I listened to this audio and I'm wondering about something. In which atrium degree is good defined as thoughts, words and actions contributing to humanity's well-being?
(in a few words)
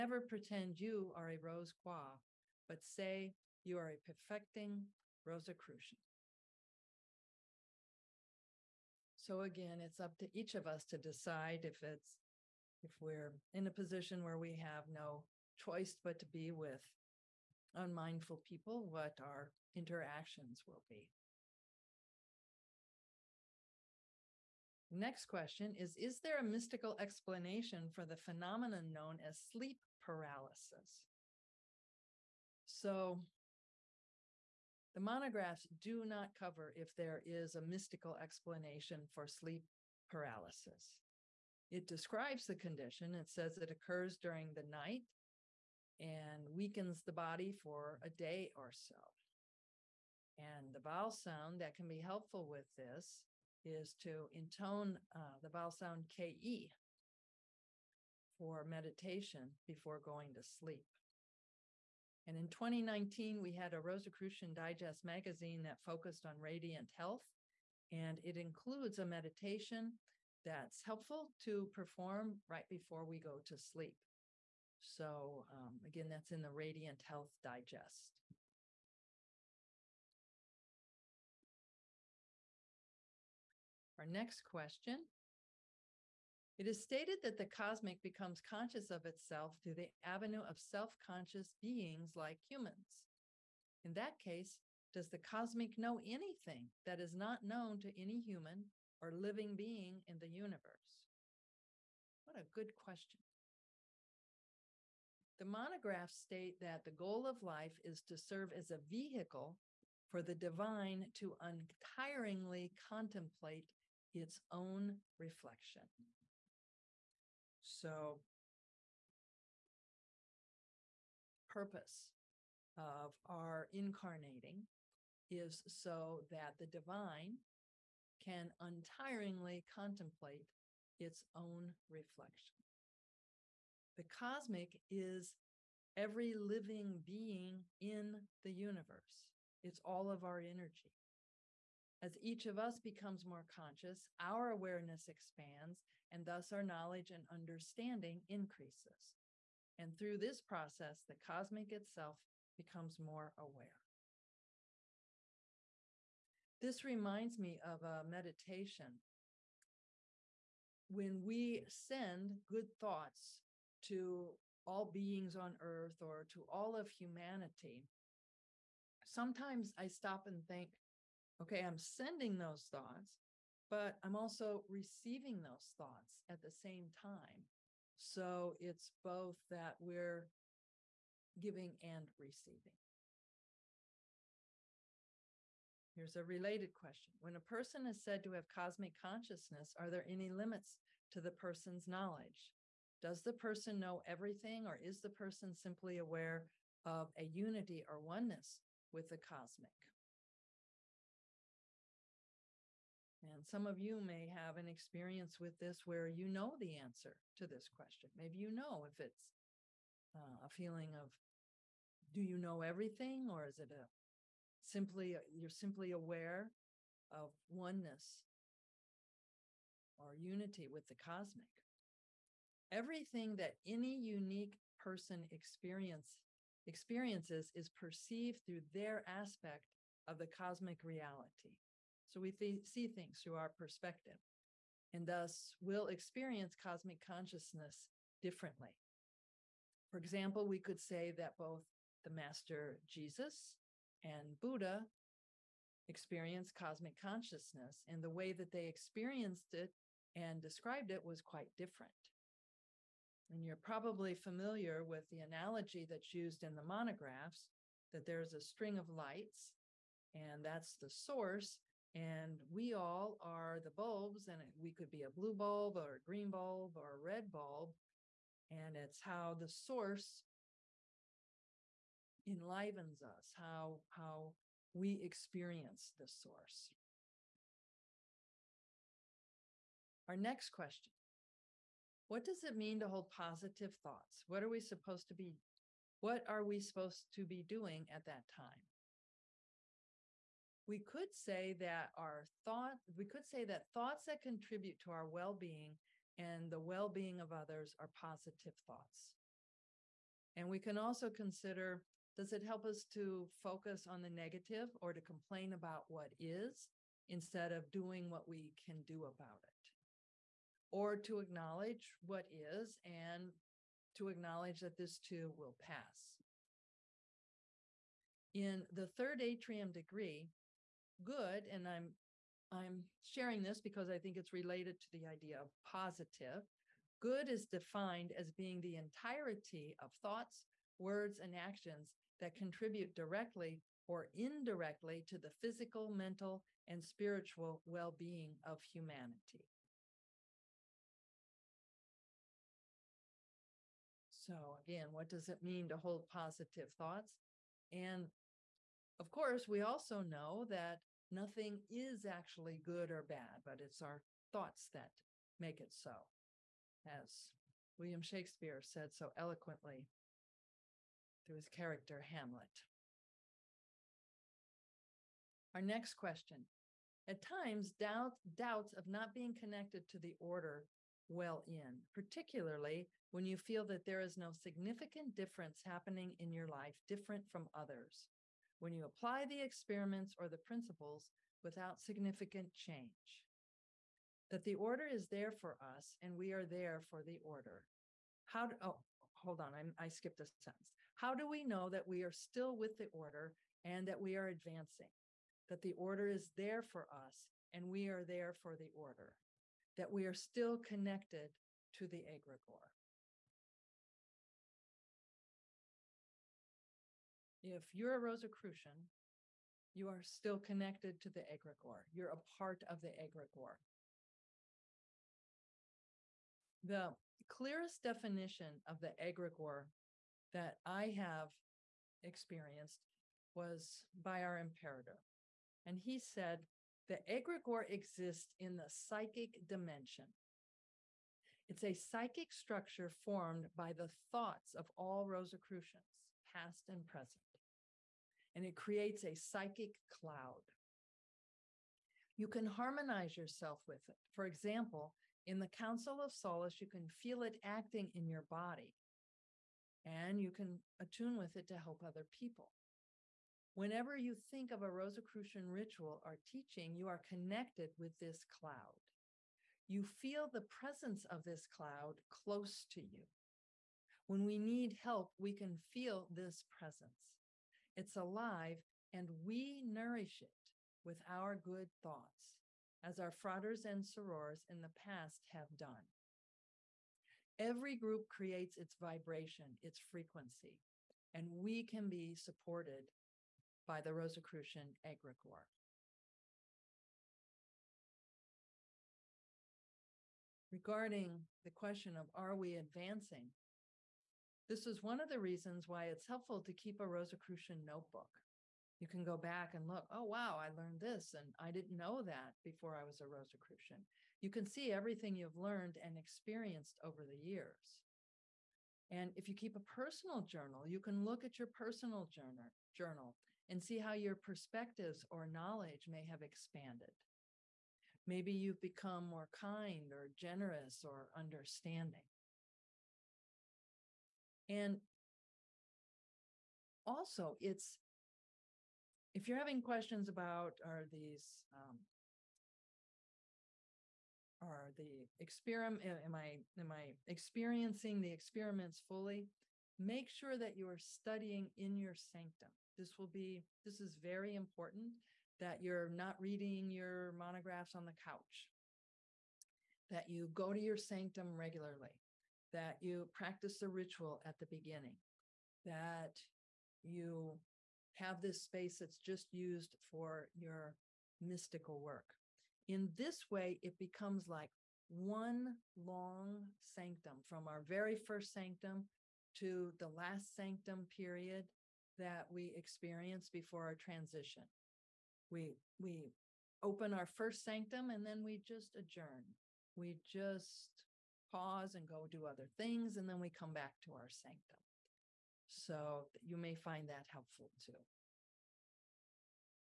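third.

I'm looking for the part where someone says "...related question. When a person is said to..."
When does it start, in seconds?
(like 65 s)
186 s.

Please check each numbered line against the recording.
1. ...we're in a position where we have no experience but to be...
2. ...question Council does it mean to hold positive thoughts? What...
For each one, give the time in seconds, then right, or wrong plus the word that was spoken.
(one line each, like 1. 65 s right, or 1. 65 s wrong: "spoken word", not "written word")
1. 12 s wrong: "choice", not "experience"
2. 280 s wrong: "What", not "Council".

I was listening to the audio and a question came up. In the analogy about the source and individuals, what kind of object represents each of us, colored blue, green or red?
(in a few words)
bulbs.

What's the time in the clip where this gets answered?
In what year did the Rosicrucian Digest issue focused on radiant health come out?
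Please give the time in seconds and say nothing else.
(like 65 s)
62 s.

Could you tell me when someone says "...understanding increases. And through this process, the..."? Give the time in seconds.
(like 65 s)
147 s.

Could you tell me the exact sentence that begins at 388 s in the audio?
How do, oh, hold on, i I skipped a sentence.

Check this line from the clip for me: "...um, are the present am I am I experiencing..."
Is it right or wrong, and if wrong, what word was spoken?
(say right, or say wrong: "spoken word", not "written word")
wrong: "experiment", not "present".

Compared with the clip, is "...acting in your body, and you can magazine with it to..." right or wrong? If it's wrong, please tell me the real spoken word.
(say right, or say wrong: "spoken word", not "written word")
wrong: "attune", not "magazine".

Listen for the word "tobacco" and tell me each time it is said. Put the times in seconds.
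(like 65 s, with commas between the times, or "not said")
not said.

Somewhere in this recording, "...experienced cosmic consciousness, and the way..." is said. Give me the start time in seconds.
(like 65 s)
245 s.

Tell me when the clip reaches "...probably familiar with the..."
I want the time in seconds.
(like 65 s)
253 s.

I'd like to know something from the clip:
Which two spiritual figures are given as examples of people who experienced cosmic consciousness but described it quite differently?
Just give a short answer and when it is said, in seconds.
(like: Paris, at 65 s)
Jesus and Buddha, at 242 s.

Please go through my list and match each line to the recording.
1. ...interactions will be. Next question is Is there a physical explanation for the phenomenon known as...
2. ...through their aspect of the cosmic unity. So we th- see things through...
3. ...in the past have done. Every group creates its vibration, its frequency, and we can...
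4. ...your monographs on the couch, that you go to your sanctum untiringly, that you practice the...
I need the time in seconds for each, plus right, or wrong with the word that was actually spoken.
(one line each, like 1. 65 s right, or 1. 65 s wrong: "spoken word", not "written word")
1. 19 s wrong: "mystical", not "physical"
2. 228 s wrong: "reality", not "unity"
3. 474 s right
4. 546 s wrong: "regularly", not "untiringly".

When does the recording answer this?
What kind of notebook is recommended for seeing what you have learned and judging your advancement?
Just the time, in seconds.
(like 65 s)
496 s.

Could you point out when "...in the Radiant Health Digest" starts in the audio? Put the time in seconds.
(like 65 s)
76 s.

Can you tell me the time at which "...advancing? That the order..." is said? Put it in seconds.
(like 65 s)
394 s.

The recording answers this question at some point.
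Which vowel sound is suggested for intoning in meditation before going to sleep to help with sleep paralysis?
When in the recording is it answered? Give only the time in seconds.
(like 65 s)
56 s.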